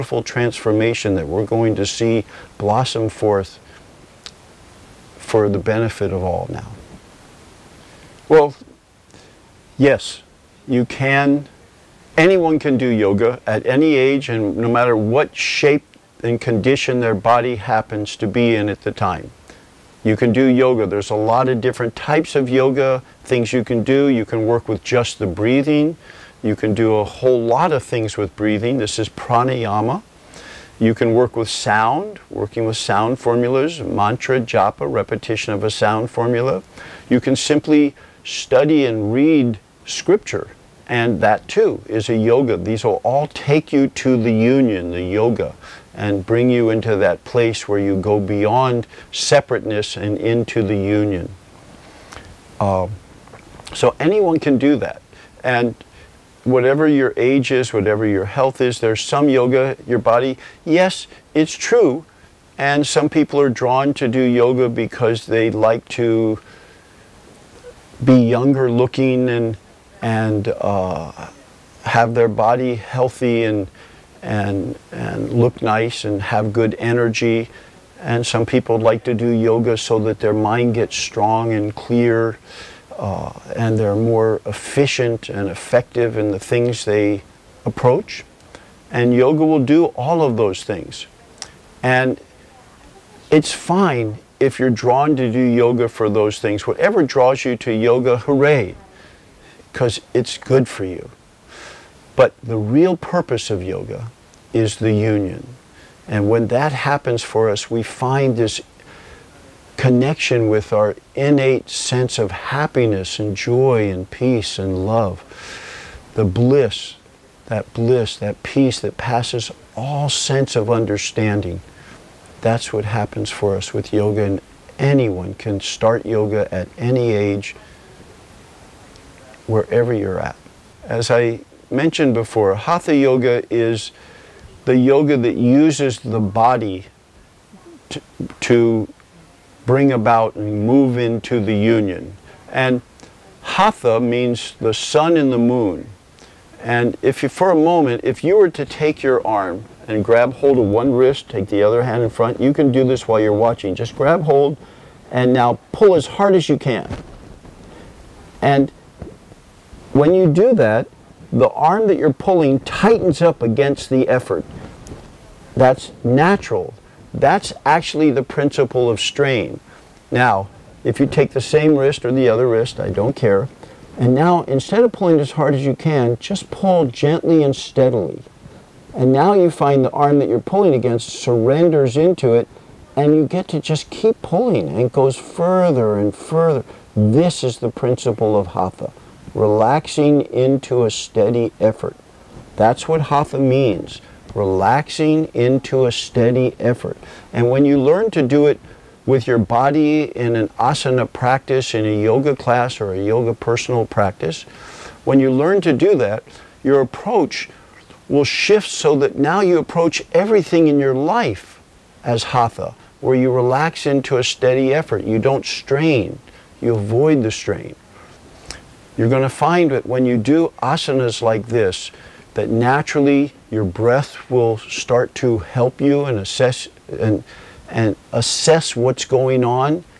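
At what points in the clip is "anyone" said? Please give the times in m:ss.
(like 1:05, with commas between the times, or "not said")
0:12, 0:53, 2:04.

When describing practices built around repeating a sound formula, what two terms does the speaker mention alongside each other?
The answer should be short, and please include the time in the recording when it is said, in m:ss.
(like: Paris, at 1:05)
Mantra, japa, at 0:33.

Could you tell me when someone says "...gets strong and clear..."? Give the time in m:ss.
1:20.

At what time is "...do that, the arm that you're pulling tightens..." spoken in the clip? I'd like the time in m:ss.
2:40.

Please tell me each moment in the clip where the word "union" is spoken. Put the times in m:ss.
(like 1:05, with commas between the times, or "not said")
0:44, 0:50, 1:44, 2:21.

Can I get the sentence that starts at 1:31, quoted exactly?
And it's fine if you're drawn to do yoga for those things.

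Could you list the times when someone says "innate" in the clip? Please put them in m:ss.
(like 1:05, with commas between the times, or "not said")
1:51.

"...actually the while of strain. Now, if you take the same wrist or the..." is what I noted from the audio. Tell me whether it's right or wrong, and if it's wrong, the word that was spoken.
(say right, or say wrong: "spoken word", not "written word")
wrong: "principle", not "while".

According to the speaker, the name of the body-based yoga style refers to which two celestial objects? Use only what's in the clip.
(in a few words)
The sun and the moon.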